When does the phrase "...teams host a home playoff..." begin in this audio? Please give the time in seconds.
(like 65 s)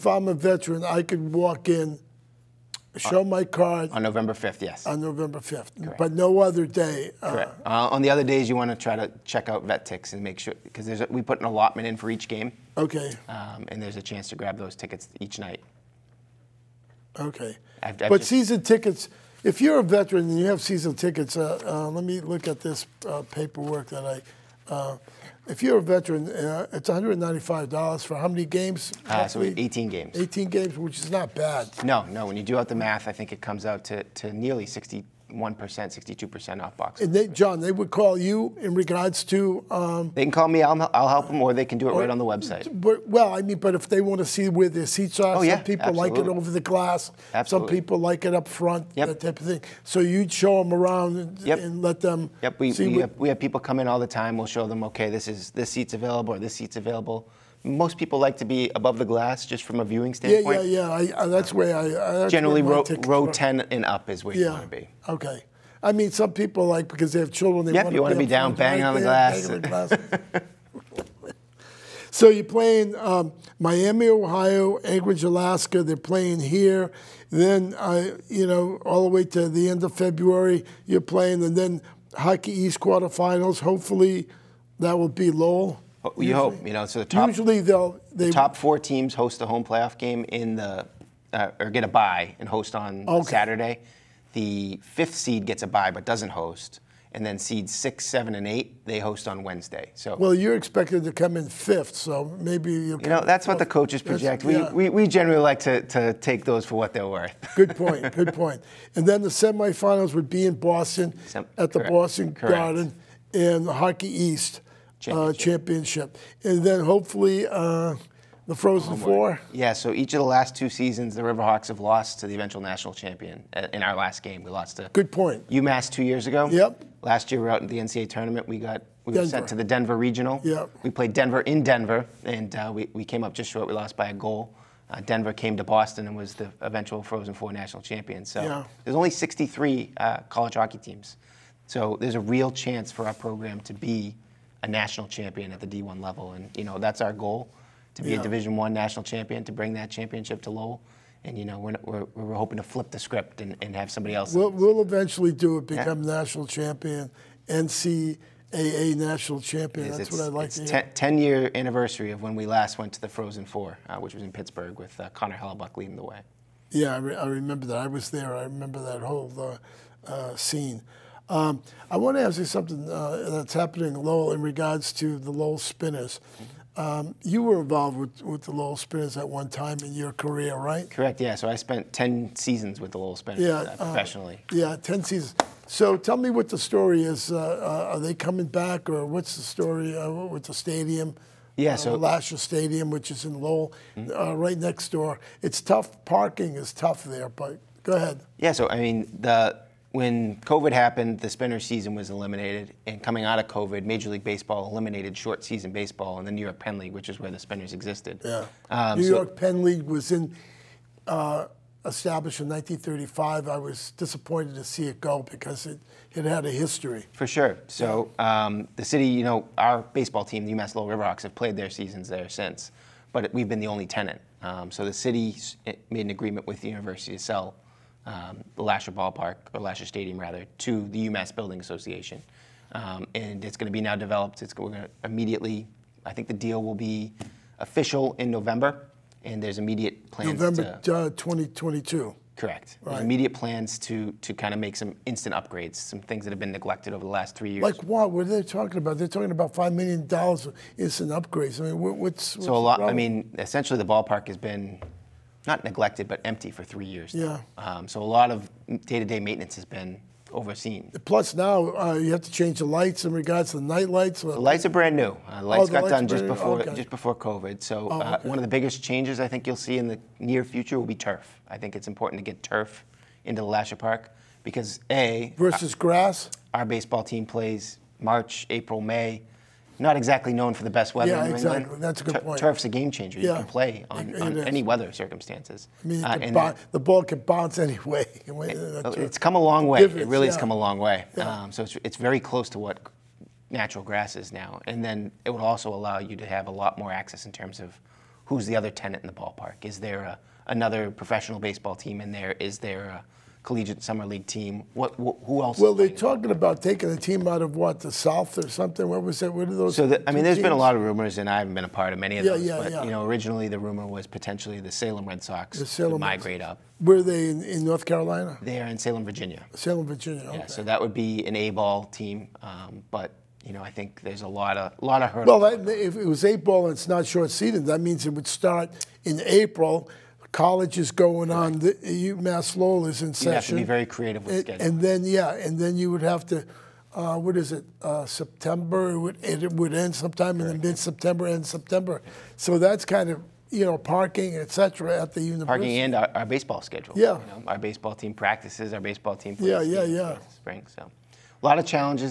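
88 s.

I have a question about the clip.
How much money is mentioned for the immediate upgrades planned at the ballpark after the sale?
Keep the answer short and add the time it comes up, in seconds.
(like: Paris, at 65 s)
5 million dollars, at 249 s.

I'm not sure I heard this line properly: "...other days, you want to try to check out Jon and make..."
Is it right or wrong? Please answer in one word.
wrong.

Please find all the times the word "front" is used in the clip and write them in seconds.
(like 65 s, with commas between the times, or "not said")
48 s.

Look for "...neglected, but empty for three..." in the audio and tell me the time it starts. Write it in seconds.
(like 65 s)
255 s.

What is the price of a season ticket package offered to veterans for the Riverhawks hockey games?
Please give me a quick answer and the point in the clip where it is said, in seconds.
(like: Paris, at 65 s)
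$195, at 26 s.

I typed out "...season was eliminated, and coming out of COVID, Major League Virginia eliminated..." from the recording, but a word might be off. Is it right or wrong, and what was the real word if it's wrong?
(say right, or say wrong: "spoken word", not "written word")
wrong: "Baseball", not "Virginia".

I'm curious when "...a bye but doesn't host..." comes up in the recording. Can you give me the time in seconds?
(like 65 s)
95 s.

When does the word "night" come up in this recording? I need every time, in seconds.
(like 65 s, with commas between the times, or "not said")
15 s, 263 s.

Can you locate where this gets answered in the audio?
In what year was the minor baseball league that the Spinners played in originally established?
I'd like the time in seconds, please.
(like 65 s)
212 s.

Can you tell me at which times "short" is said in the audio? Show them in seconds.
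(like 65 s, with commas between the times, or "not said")
133 s, 205 s, 327 s.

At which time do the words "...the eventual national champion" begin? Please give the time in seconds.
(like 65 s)
122 s.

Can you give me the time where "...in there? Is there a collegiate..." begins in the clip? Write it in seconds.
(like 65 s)
301 s.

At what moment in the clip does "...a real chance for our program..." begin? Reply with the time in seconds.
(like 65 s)
142 s.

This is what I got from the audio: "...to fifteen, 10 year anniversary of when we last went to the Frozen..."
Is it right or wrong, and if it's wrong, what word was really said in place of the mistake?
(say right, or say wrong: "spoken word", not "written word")
wrong: "ten", not "fifteen".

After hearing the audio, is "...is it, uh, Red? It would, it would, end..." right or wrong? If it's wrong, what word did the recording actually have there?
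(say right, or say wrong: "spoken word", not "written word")
wrong: "September", not "Red".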